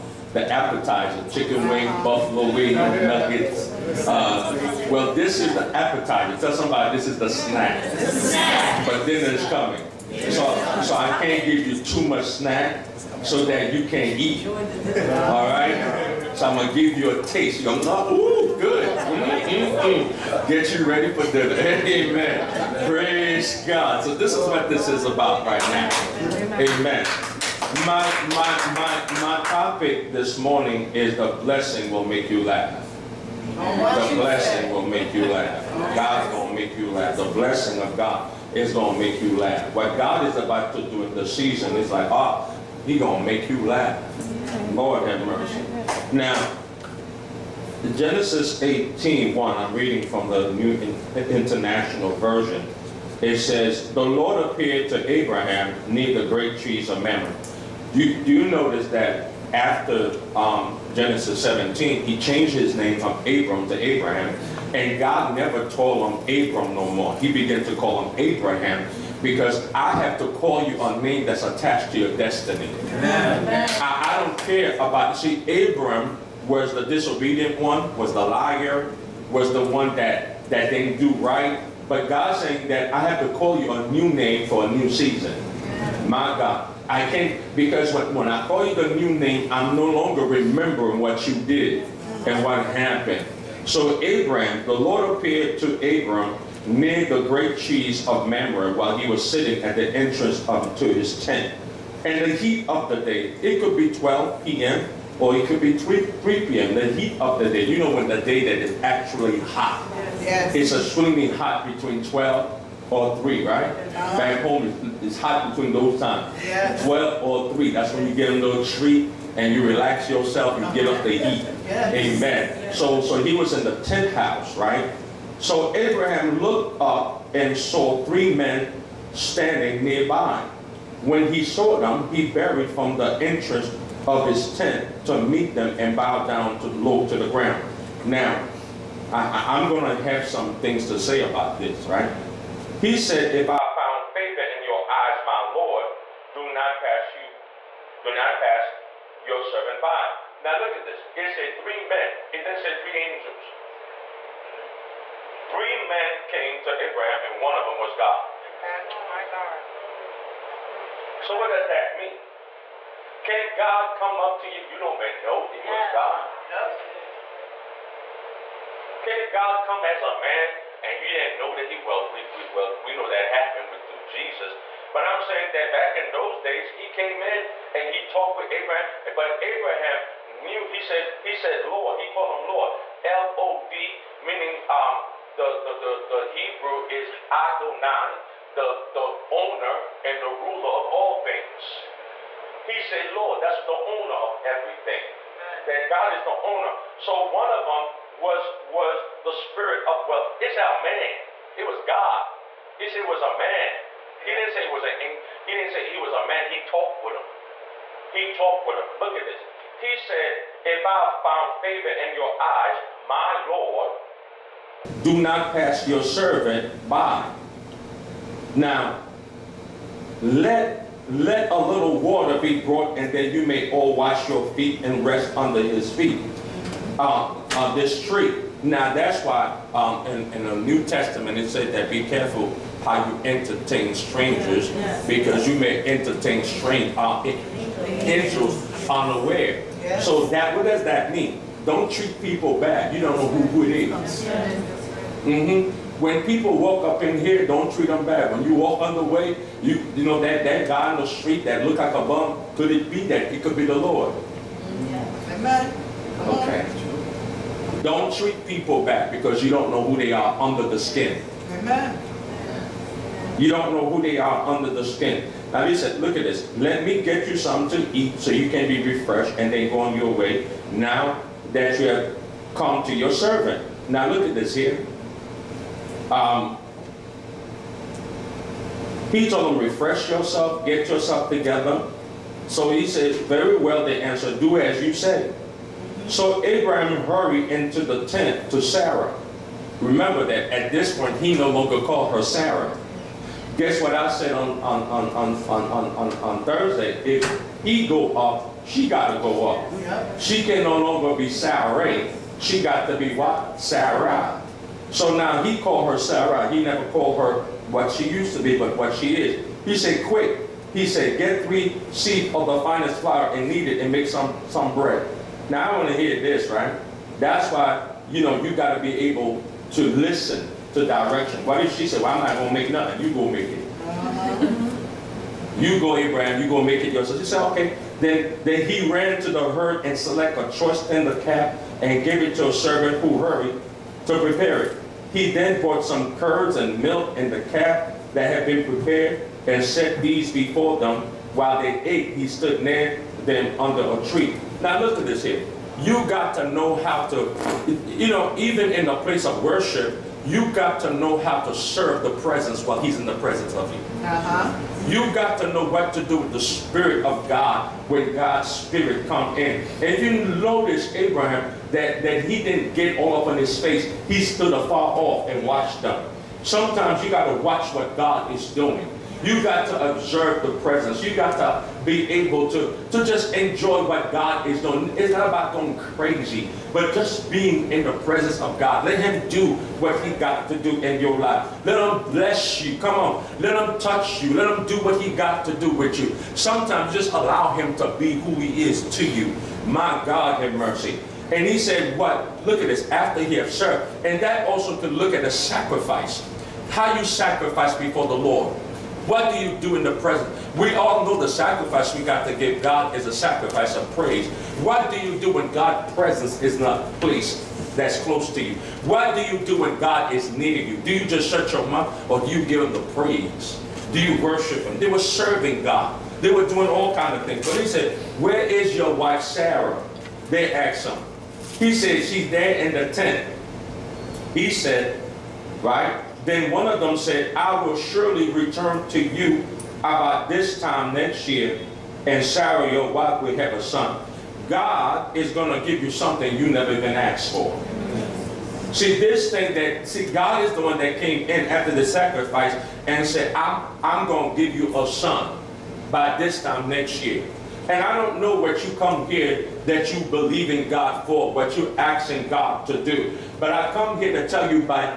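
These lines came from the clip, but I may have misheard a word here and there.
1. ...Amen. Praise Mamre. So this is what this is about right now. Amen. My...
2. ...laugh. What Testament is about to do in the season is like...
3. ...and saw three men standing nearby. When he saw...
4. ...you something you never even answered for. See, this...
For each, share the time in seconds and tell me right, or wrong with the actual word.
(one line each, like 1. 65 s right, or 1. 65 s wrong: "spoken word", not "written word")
1. 21 s wrong: "God", not "Mamre"
2. 39 s wrong: "God", not "Testament"
3. 127 s right
4. 435 s wrong: "asked", not "answered".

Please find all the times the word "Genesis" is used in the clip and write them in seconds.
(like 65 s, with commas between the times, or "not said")
47 s, 60 s.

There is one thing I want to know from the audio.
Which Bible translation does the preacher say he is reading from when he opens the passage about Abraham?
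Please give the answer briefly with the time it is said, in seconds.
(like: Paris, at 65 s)
New International Version, at 50 s.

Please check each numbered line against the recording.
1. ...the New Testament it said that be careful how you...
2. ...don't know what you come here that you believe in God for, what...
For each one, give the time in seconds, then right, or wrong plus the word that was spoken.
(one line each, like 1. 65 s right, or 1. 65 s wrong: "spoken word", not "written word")
1. 230 s right
2. 447 s right.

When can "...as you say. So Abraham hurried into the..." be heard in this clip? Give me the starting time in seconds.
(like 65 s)
284 s.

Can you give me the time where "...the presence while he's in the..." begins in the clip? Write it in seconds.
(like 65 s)
352 s.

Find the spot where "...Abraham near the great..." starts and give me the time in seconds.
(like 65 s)
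55 s.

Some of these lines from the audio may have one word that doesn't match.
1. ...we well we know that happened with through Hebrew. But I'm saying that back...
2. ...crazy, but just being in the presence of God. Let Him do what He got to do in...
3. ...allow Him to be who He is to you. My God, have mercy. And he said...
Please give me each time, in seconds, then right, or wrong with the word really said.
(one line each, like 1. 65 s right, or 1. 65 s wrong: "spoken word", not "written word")
1. 172 s wrong: "Jesus", not "Hebrew"
2. 375 s right
3. 387 s right.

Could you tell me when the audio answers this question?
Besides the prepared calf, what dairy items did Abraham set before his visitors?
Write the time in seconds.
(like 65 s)
336 s.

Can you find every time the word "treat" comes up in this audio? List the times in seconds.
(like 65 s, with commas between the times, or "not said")
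118 s, 241 s, 247 s, 258 s.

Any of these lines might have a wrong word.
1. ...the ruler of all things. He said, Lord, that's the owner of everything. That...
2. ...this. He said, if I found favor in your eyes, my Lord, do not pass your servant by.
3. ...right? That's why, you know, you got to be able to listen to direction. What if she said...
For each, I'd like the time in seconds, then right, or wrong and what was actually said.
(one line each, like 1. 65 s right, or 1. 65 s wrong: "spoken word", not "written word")
1. 190 s right
2. 209 s right
3. 316 s right.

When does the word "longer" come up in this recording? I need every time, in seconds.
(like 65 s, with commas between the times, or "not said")
89 s, 291 s, 300 s.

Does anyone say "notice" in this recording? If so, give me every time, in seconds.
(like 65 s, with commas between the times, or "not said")
58 s, 360 s.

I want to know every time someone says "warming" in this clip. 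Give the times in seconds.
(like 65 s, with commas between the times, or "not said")
not said.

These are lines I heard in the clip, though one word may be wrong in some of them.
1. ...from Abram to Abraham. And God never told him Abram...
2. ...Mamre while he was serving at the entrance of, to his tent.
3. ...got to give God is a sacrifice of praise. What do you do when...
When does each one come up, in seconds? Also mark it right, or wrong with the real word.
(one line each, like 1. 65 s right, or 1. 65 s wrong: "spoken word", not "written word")
1. 62 s right
2. 98 s wrong: "sitting", not "serving"
3. 402 s right.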